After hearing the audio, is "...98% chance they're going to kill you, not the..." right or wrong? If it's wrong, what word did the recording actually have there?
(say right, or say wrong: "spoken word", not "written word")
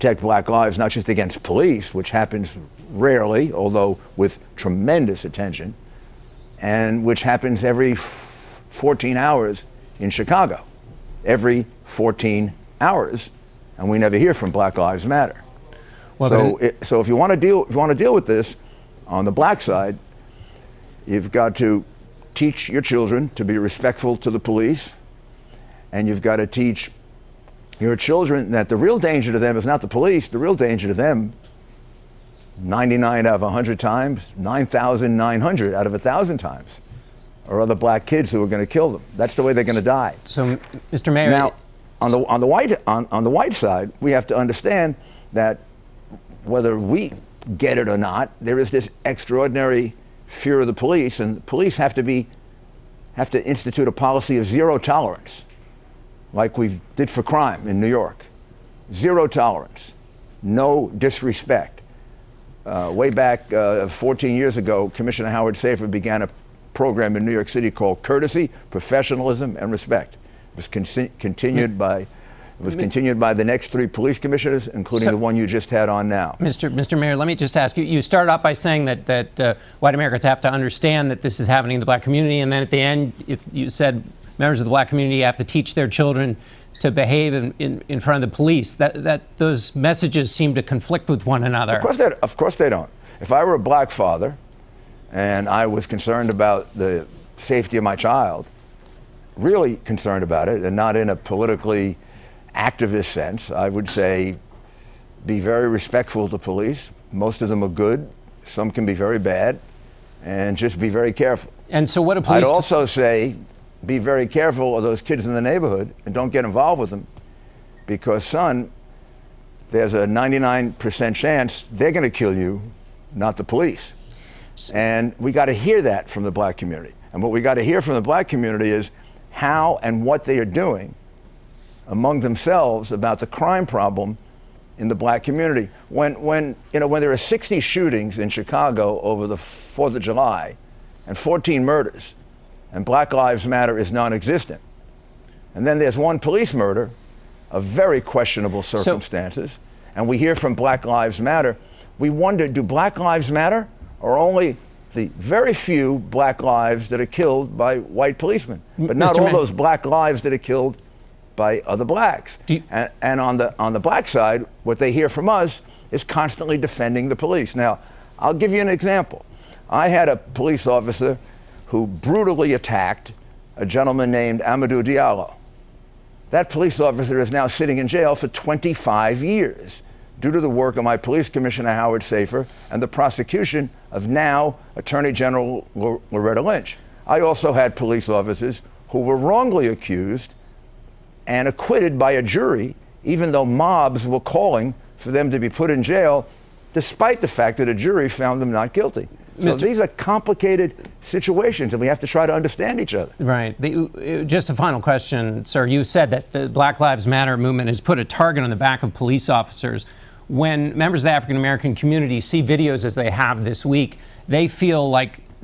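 wrong: "99", not "98".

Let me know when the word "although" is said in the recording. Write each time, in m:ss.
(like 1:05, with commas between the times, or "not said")
0:03.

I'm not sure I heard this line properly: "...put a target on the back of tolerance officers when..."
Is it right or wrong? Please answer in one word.
wrong.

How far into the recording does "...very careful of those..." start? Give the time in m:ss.
1:53.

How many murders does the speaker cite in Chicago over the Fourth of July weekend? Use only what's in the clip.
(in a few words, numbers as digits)
14.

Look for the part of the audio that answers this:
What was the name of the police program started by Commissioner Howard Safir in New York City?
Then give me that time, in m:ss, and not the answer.
1:08.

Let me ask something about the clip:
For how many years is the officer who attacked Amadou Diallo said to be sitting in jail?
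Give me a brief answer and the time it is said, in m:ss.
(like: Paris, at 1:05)
25, at 2:58.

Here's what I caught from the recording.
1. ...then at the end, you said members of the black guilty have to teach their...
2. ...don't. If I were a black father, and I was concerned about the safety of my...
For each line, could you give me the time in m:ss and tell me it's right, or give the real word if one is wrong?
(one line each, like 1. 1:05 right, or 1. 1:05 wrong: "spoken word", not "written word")
1. 1:22 wrong: "community", not "guilty"
2. 1:32 right.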